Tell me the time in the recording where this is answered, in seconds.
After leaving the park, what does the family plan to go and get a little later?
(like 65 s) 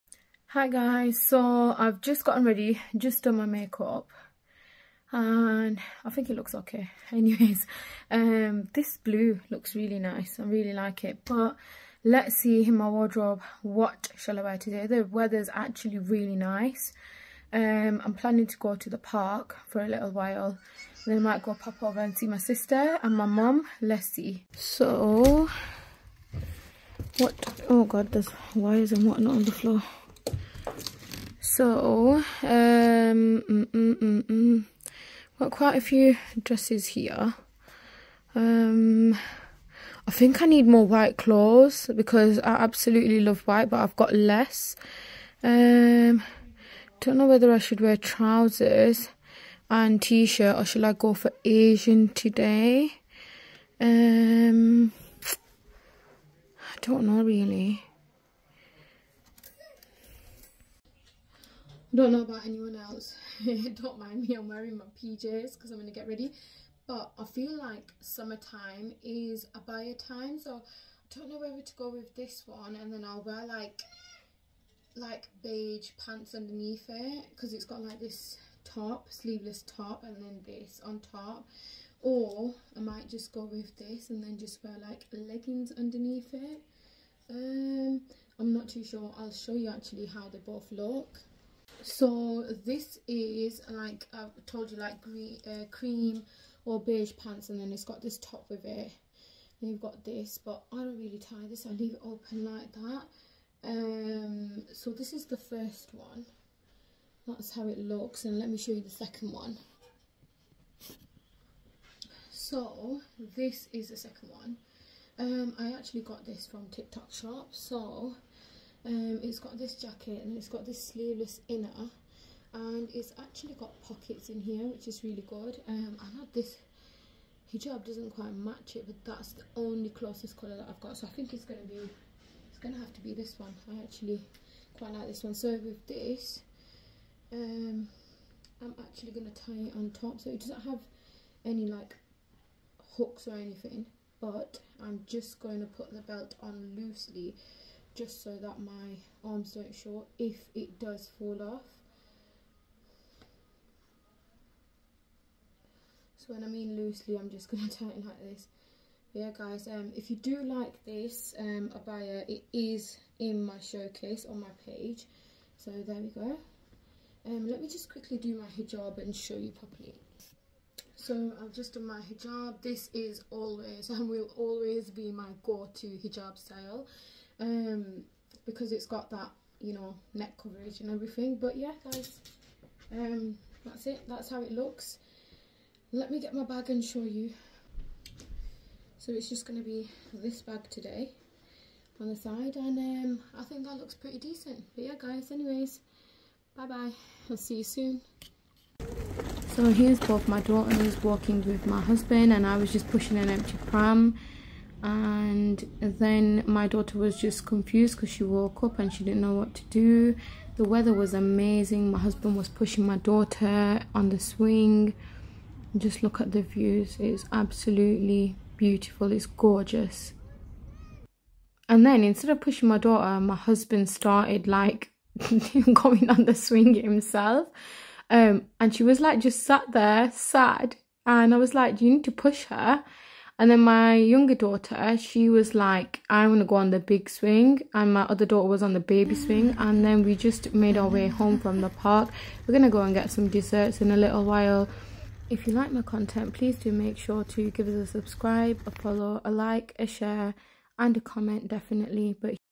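243 s.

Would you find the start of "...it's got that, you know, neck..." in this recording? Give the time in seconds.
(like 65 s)
178 s.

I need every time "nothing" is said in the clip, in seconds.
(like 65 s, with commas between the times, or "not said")
not said.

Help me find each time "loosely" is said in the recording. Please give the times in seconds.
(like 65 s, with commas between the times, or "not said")
146 s, 156 s.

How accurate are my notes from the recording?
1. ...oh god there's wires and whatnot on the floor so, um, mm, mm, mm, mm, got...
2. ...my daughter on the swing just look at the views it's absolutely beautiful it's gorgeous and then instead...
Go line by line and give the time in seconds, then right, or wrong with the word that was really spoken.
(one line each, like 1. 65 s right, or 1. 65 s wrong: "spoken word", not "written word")
1. 27 s right
2. 212 s right.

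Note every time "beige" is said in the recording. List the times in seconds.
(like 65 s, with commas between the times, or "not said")
75 s, 96 s.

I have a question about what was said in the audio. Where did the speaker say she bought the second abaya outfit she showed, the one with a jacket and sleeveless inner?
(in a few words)
TikTok Shop.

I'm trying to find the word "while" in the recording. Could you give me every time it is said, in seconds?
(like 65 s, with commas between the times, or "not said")
20 s, 244 s.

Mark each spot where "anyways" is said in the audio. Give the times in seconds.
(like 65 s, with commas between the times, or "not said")
7 s, 195 s.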